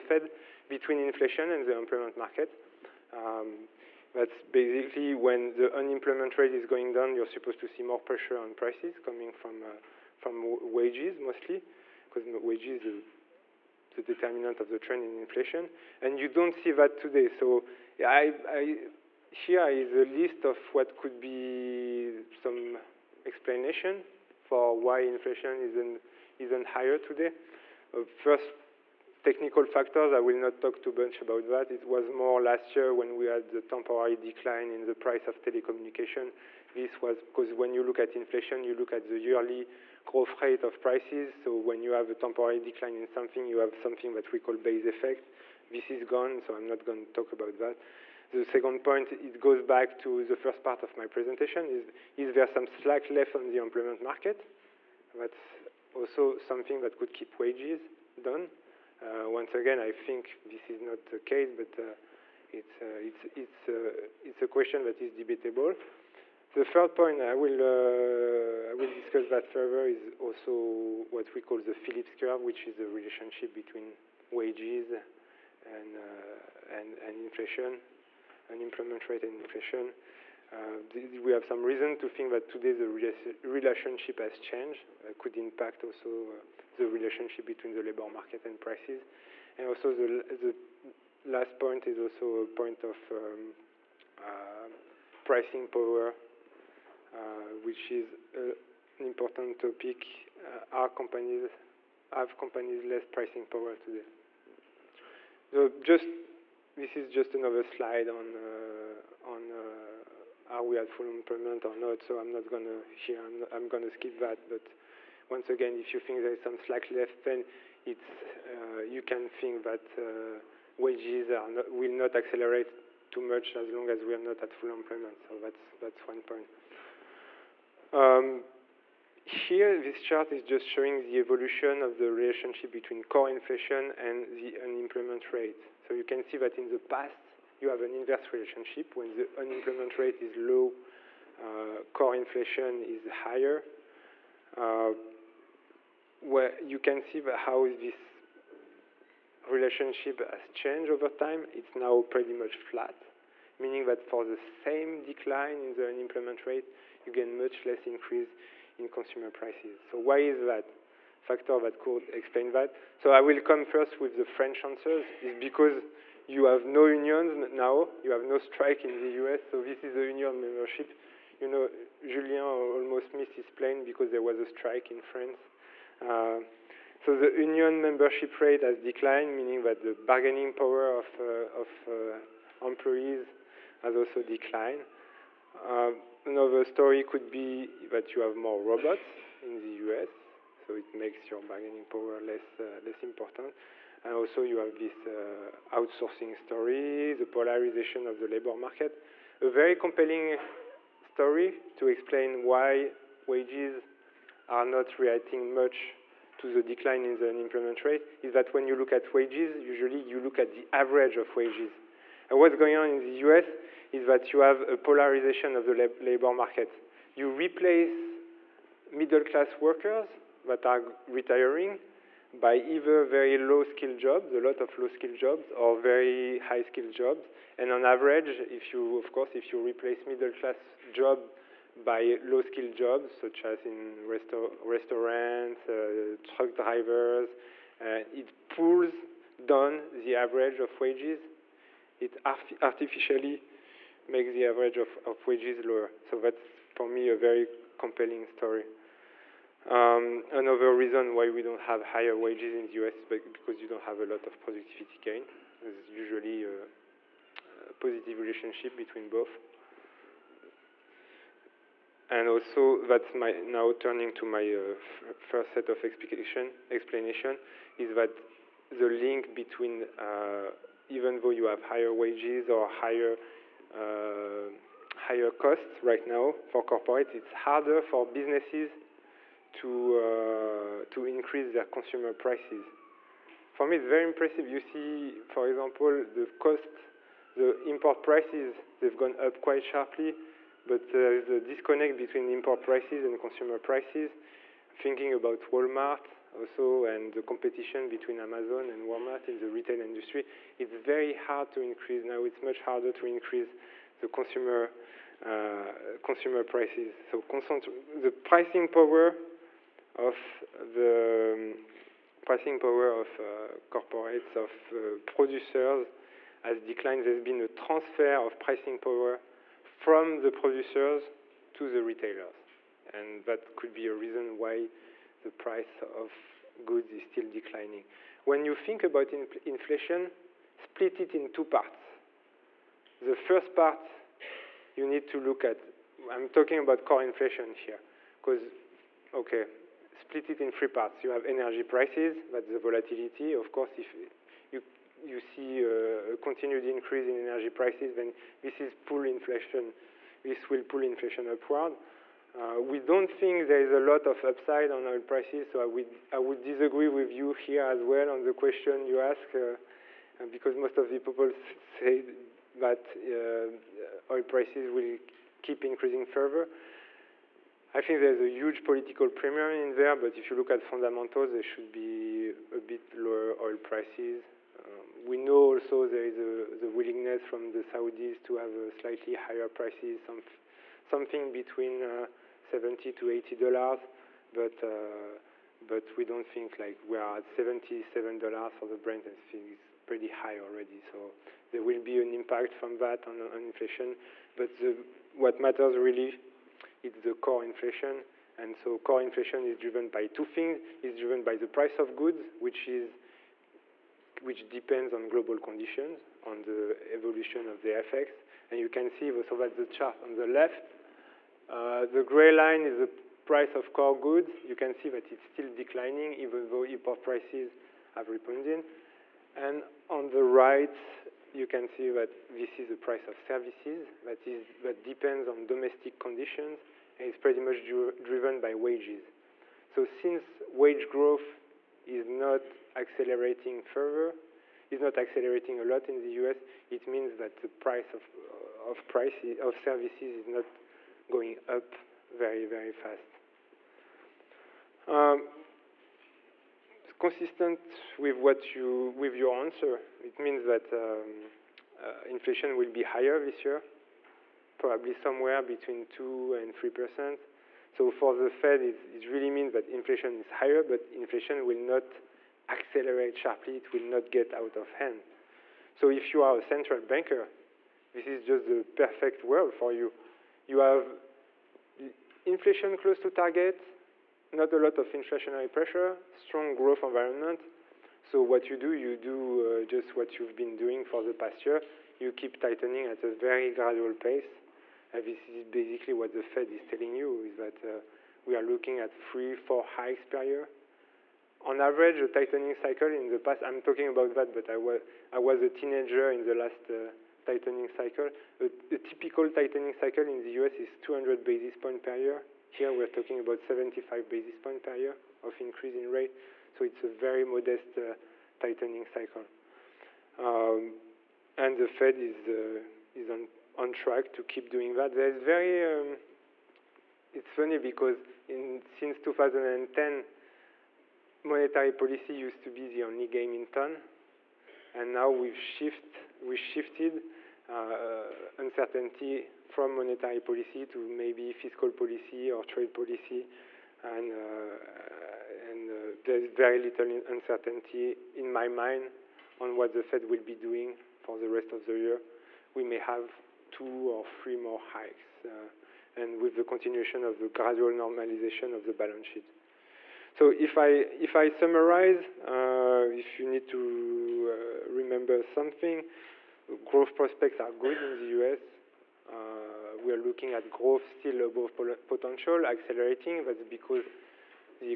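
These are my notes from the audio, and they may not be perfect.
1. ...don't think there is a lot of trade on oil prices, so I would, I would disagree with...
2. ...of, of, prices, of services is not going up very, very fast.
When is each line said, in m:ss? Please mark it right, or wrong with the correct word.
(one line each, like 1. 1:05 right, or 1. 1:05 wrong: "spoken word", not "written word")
1. 5:52 wrong: "upside", not "trade"
2. 7:17 right.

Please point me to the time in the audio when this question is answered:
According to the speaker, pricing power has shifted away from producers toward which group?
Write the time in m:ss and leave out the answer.
5:21.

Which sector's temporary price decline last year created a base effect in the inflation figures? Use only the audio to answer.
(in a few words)
Telecommunication.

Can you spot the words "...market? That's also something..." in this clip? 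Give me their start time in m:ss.
0:53.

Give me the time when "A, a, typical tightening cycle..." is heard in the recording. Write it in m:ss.
8:18.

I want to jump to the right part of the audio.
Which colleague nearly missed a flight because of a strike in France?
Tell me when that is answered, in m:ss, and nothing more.
2:52.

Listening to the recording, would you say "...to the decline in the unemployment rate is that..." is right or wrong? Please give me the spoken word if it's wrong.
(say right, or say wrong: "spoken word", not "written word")
right.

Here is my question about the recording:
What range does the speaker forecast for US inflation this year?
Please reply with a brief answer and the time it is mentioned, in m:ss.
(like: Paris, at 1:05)
2 to 3%, at 7:35.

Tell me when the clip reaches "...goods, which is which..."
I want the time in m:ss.
6:41.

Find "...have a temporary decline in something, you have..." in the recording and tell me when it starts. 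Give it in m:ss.
0:41.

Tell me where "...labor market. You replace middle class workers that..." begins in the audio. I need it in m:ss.
3:35.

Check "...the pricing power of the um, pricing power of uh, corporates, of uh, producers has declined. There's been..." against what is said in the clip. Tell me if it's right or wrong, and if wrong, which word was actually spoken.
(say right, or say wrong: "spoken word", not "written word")
right.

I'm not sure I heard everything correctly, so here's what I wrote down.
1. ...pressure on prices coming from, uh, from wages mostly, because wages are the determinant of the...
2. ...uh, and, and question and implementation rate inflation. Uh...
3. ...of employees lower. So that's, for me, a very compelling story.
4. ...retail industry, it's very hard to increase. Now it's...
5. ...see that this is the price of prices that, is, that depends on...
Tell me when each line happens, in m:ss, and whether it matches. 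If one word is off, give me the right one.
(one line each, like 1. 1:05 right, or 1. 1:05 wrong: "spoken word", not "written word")
1. 0:07 right
2. 1:15 wrong: "inflation", not "question"
3. 4:05 wrong: "wages", not "employees"
4. 4:59 right
5. 7:01 wrong: "services", not "prices".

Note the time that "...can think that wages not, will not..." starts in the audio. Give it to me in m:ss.
1:59.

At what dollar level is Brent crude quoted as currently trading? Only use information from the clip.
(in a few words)
$77.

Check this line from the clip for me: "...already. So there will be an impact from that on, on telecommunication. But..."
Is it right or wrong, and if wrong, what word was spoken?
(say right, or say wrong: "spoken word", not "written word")
wrong: "inflation", not "telecommunication".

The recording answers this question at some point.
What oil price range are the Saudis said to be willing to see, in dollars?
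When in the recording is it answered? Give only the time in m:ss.
6:22.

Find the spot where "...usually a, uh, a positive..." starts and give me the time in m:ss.
4:15.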